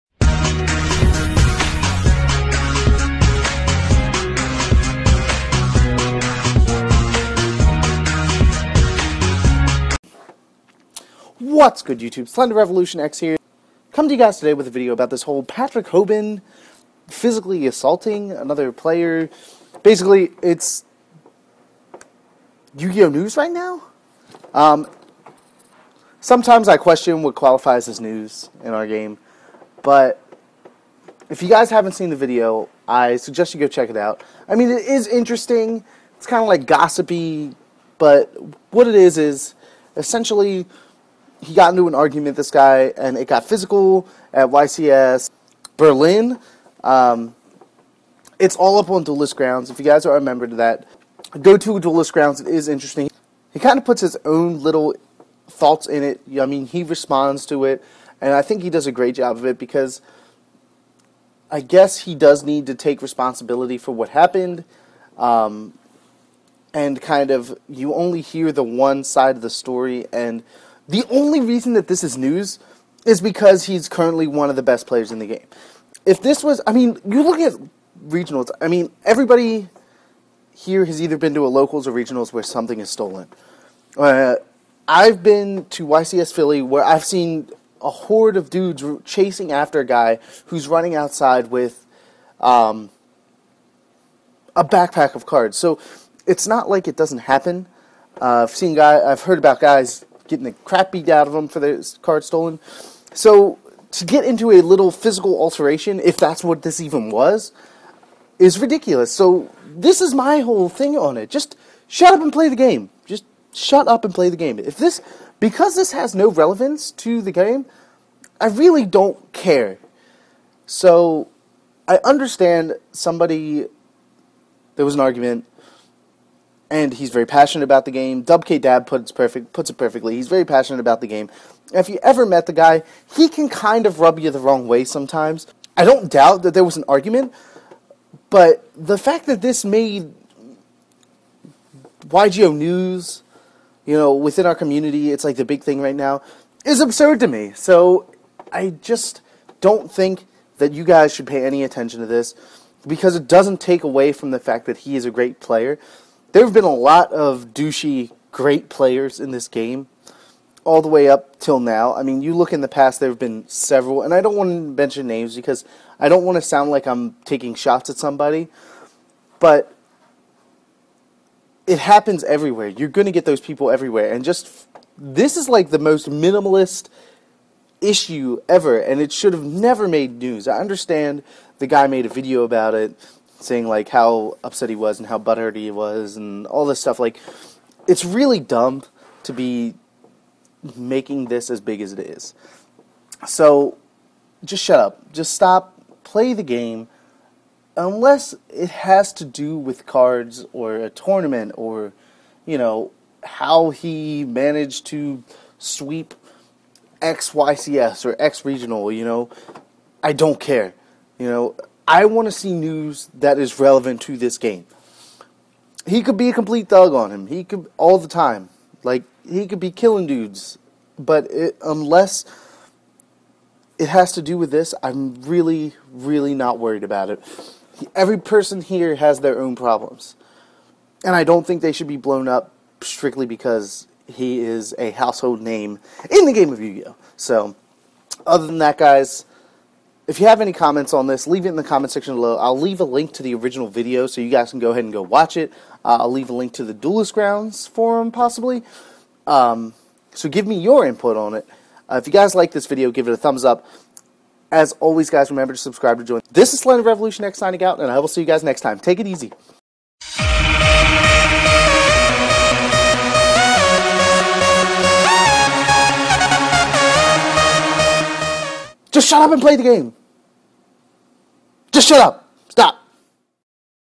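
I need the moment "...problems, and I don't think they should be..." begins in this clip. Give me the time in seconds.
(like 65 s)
229 s.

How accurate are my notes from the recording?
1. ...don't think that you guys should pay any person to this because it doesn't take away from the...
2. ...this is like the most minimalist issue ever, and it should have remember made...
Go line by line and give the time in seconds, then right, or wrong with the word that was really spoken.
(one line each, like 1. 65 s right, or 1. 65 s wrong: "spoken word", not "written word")
1. 149 s wrong: "attention", not "person"
2. 174 s wrong: "never", not "remember".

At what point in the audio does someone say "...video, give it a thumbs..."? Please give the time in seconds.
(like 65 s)
252 s.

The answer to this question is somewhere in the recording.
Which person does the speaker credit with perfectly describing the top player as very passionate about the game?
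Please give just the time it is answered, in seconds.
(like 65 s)
128 s.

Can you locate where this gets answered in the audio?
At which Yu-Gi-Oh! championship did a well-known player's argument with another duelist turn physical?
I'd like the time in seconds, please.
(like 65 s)
44 s.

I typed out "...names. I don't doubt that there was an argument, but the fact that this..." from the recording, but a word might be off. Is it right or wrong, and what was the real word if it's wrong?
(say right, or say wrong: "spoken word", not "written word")
wrong: "sometimes", not "names".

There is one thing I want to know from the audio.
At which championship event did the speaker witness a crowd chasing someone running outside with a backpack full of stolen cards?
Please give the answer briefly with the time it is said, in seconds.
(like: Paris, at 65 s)
YCS Philly, at 85 s.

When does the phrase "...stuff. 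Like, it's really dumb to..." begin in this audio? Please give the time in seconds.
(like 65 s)
186 s.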